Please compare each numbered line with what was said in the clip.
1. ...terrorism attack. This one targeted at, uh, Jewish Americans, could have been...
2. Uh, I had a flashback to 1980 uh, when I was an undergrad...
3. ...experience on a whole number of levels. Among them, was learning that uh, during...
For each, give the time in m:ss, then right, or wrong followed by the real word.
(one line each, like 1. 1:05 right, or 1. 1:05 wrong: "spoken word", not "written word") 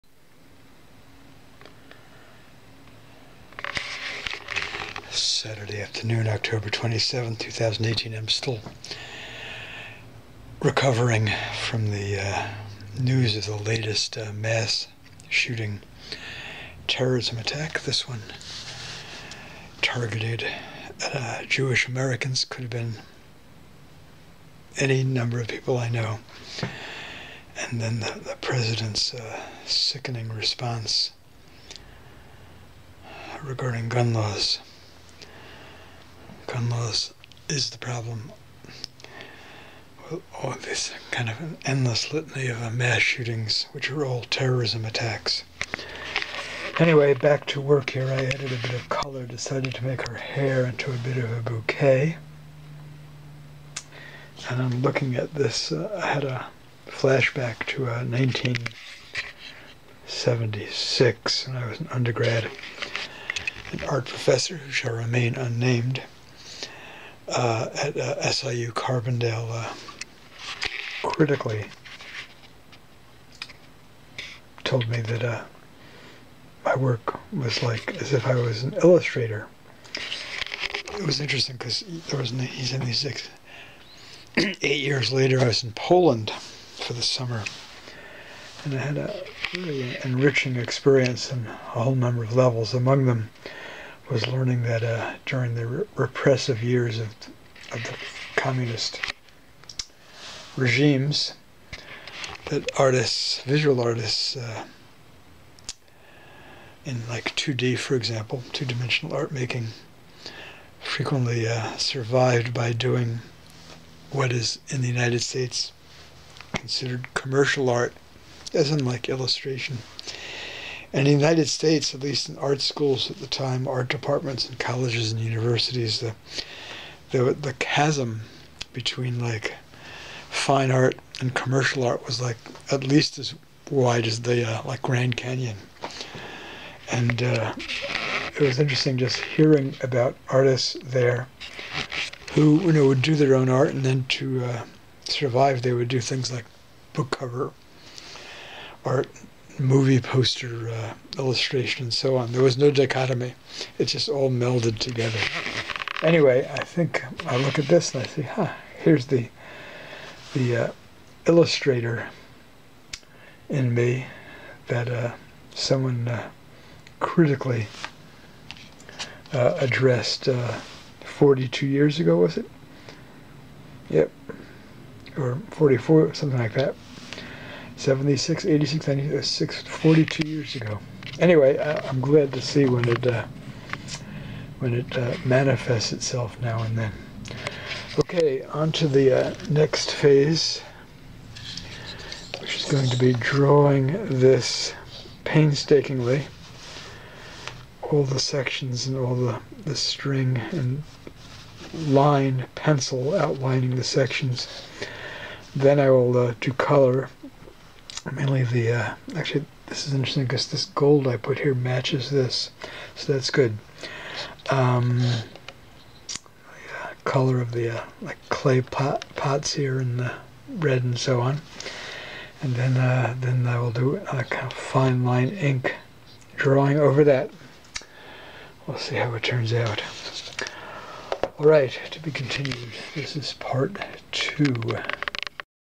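1. 0:16 right
2. 0:55 wrong: "1976", not "1980"
3. 1:30 right.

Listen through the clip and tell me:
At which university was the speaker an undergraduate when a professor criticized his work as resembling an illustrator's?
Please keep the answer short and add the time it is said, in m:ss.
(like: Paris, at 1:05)
SIU Carbondale, at 1:08.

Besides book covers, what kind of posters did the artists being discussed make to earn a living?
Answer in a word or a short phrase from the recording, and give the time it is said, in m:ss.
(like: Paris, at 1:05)
movie poster, at 2:29.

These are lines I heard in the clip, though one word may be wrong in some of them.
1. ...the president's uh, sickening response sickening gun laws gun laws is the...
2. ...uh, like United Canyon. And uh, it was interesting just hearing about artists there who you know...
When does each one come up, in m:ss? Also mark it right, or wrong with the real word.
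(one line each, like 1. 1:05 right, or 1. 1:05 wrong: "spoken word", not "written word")
1. 0:28 wrong: "regarding", not "sickening"
2. 2:14 wrong: "Grand", not "United".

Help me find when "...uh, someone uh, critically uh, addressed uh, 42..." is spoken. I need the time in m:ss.
2:44.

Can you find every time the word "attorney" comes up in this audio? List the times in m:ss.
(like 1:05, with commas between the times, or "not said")
not said.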